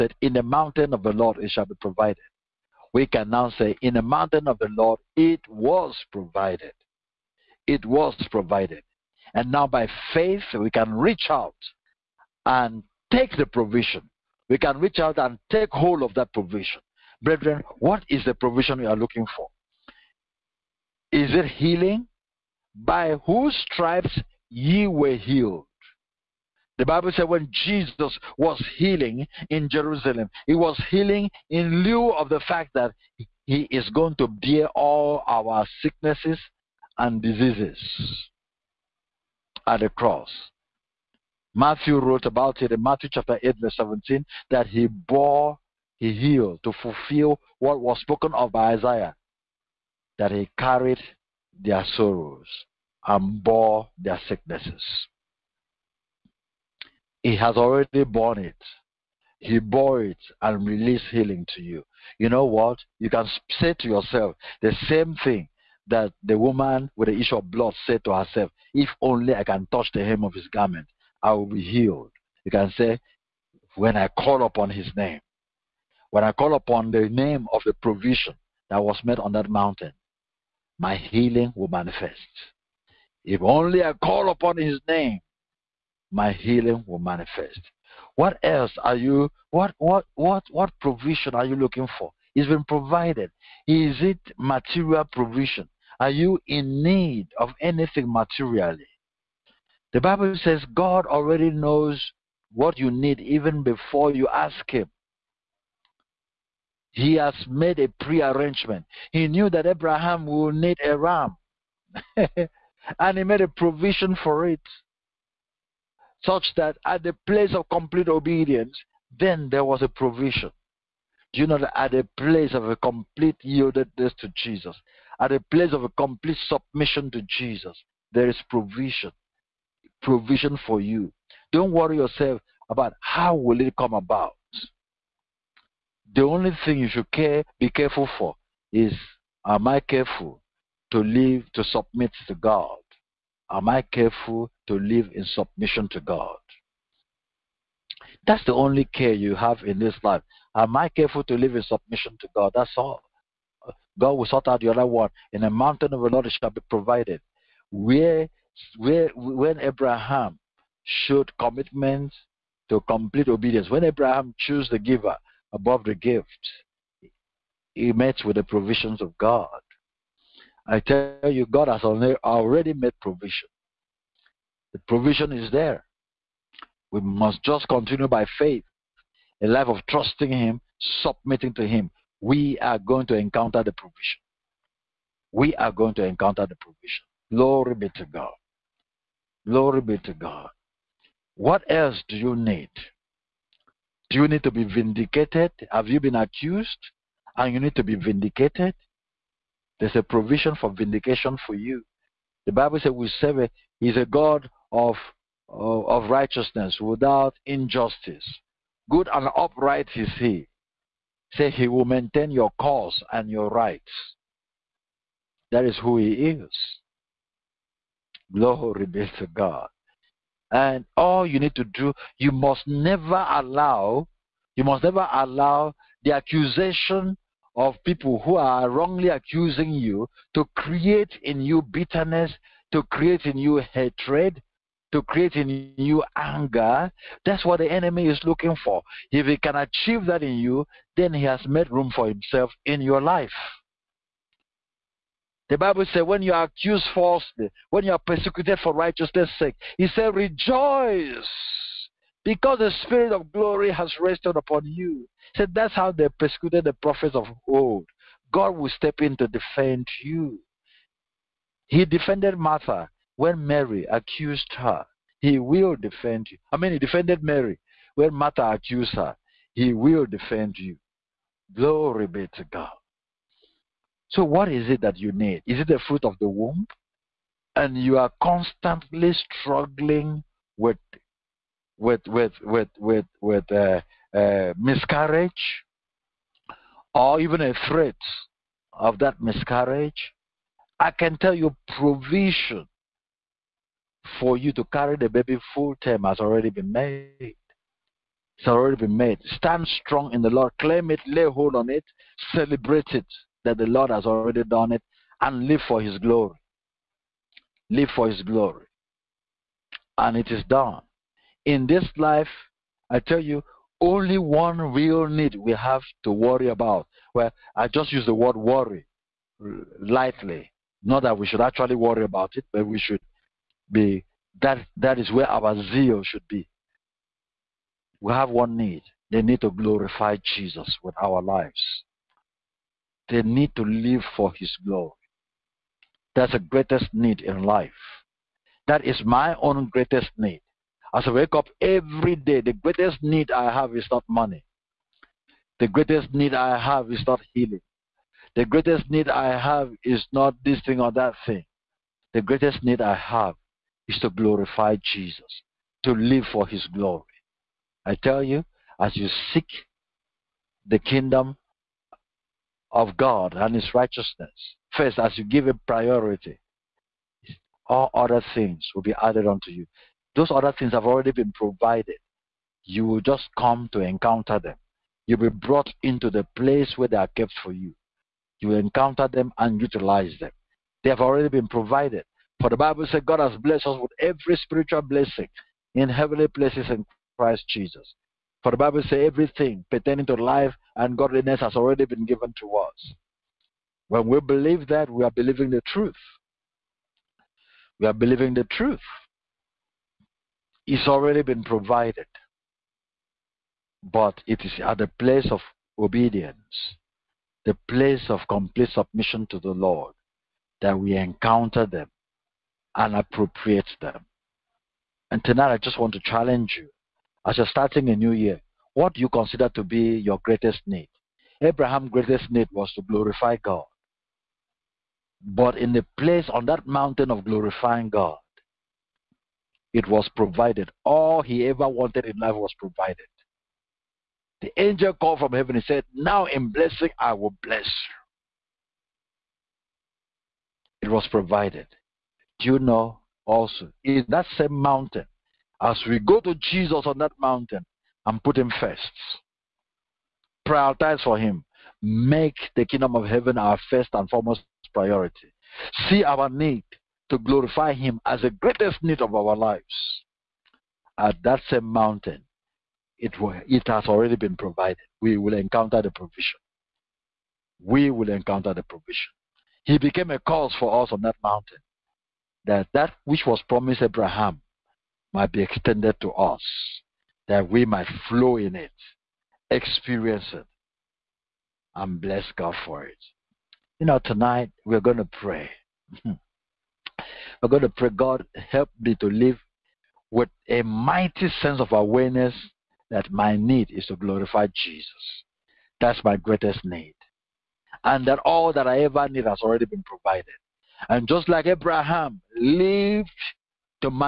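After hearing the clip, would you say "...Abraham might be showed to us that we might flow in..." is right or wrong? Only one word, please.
wrong.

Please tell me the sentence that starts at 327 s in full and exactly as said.
We have one need, the need to glorify Jesus with our lives they need to live for His glory.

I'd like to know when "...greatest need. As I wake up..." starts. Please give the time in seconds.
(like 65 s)
339 s.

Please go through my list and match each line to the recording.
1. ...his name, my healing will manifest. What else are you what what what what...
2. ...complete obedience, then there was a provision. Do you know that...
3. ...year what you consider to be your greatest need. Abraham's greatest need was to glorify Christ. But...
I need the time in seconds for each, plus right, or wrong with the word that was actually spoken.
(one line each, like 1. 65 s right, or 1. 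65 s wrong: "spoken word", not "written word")
1. 84 s right
2. 117 s right
3. 418 s wrong: "God", not "Christ".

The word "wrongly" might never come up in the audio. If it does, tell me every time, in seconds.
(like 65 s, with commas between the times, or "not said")
228 s.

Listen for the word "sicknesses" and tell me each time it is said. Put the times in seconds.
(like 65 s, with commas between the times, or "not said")
35 s, 54 s.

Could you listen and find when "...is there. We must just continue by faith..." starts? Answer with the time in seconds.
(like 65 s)
175 s.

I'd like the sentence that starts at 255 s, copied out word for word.
He said, that's how they persecuted the prophets of old.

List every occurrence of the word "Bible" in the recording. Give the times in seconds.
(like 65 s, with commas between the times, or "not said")
26 s, 99 s, 202 s, 245 s, 382 s, 388 s.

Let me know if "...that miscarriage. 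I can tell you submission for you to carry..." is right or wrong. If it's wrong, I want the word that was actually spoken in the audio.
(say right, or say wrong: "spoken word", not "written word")
wrong: "provision", not "submission".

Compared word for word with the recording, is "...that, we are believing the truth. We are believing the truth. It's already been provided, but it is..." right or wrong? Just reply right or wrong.
right.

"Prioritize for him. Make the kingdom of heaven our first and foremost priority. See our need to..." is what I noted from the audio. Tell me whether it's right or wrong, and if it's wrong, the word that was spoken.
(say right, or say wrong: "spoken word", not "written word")
right.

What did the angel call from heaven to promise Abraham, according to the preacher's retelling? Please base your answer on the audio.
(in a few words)
In blessing I will bless you.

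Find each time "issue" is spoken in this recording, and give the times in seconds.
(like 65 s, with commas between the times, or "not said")
67 s.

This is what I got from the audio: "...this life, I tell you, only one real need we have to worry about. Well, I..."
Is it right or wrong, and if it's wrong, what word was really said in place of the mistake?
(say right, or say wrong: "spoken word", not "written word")
right.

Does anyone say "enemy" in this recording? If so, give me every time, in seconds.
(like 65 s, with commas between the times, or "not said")
237 s.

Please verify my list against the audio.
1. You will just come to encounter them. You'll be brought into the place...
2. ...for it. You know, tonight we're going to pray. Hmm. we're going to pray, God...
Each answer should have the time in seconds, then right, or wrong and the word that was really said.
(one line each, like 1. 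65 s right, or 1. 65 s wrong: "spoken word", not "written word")
1. 372 s right
2. 482 s right.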